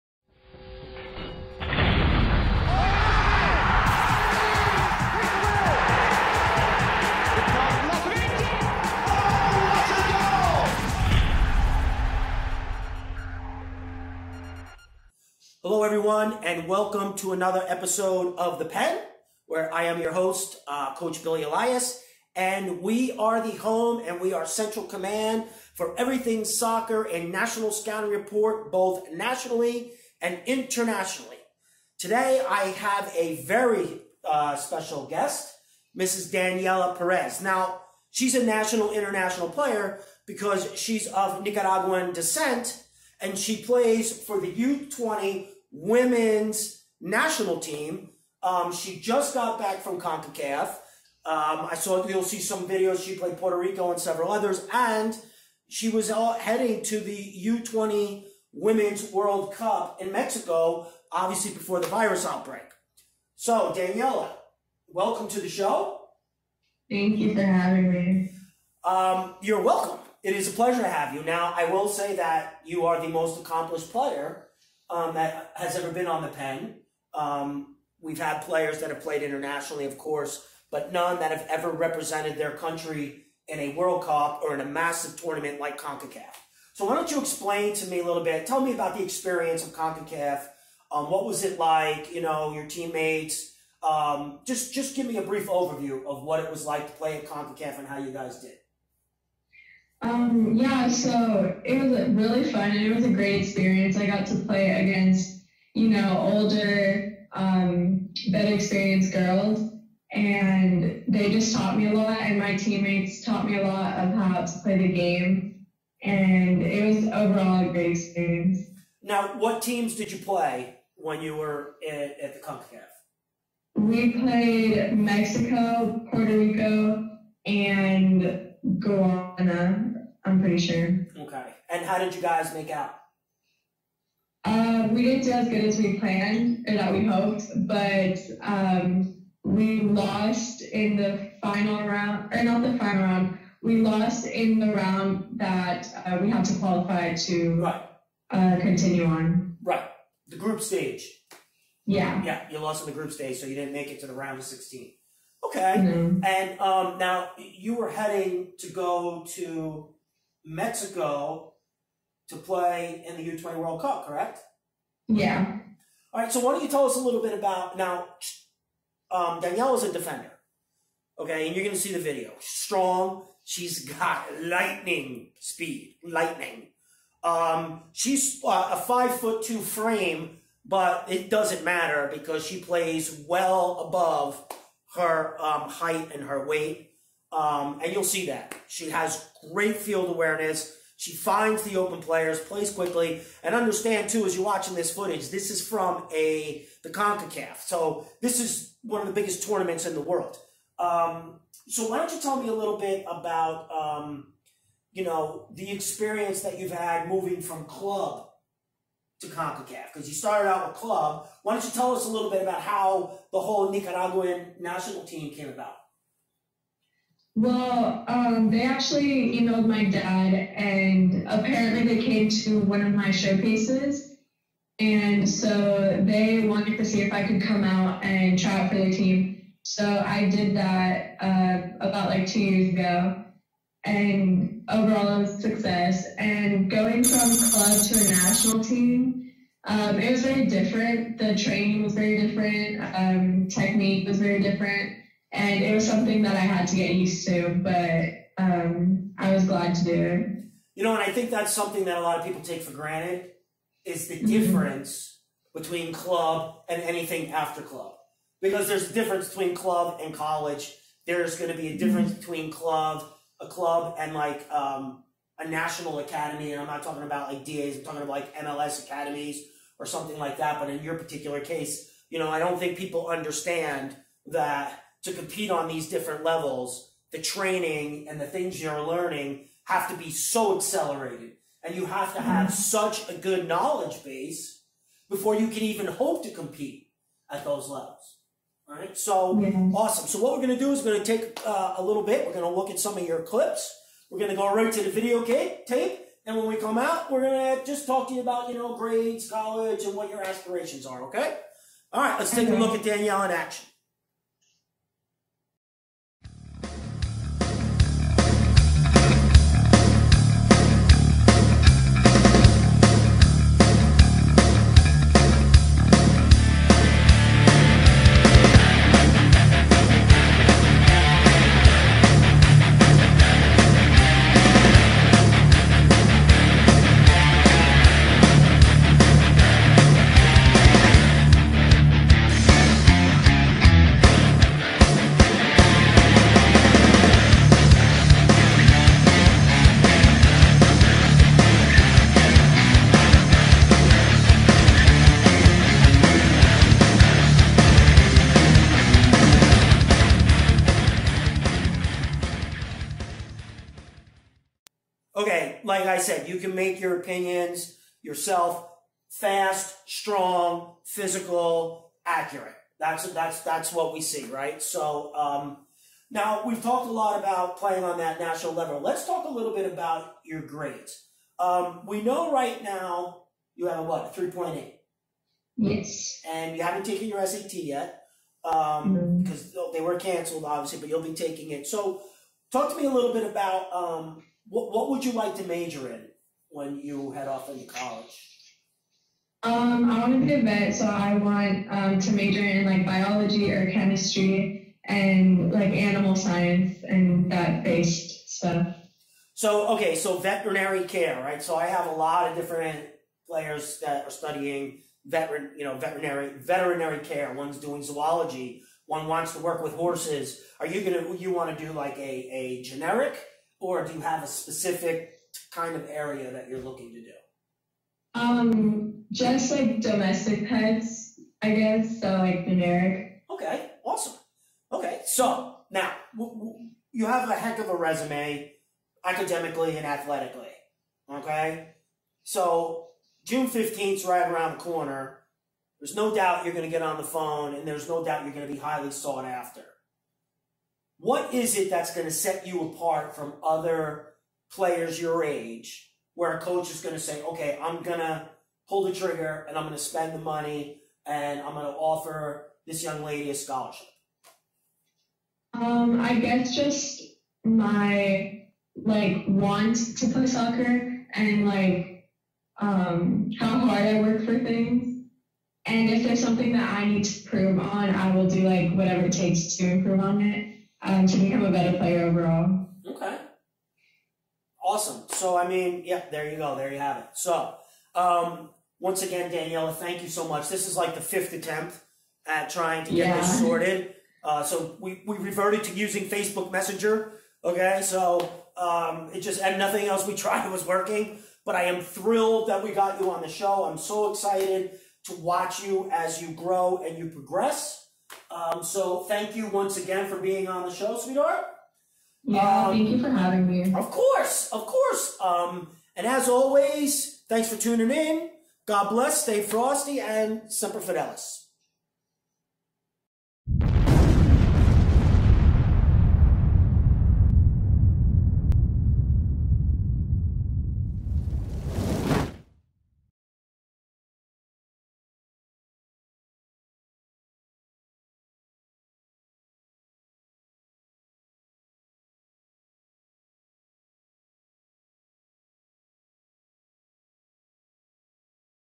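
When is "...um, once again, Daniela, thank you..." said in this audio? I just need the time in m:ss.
7:57.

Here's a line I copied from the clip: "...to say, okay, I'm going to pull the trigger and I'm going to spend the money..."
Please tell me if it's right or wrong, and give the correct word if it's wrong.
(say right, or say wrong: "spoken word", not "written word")
right.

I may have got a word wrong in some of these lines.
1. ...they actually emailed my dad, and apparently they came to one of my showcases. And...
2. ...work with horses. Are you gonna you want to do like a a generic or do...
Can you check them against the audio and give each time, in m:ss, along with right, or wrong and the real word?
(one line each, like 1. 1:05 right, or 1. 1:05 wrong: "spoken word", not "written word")
1. 3:38 right
2. 6:49 right.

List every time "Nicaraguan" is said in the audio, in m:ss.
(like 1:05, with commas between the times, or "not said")
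0:41, 3:33.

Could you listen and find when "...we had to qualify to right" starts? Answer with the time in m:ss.
2:26.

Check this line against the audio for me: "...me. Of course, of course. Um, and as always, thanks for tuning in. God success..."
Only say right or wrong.
wrong.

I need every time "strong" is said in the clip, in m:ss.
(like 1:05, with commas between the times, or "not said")
2:52, 5:59.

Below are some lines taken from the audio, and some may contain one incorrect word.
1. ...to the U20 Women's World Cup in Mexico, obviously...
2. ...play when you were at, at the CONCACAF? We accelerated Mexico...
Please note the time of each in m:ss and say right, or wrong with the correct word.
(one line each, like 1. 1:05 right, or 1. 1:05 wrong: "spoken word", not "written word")
1. 0:56 right
2. 2:00 wrong: "played", not "accelerated".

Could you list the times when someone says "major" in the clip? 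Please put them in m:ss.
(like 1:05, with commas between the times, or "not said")
6:25, 6:32.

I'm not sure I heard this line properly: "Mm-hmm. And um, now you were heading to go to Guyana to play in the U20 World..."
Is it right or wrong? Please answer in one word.
wrong.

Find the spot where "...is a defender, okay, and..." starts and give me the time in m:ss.
2:49.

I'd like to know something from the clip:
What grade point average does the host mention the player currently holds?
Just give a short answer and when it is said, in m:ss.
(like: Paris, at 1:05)
3.8, at 6:14.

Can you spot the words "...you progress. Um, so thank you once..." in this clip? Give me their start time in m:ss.
8:16.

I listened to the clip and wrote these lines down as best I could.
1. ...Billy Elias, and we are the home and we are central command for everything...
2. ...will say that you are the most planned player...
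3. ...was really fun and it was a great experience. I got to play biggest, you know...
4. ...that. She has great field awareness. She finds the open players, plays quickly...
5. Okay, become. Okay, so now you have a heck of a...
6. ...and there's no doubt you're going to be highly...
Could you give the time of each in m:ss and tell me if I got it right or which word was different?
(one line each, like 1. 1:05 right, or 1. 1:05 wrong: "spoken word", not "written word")
1. 0:21 right
2. 1:11 wrong: "accomplished", not "planned"
3. 1:41 wrong: "against", not "biggest"
4. 3:08 right
5. 7:03 wrong: "awesome", not "become"
6. 7:17 right.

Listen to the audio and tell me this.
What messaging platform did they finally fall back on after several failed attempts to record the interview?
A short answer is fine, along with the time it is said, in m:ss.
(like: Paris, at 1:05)
Facebook Messenger, at 8:06.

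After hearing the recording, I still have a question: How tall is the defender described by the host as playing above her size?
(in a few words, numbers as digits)
5 foot 2.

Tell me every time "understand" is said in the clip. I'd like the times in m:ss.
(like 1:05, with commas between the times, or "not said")
3:13, 4:33.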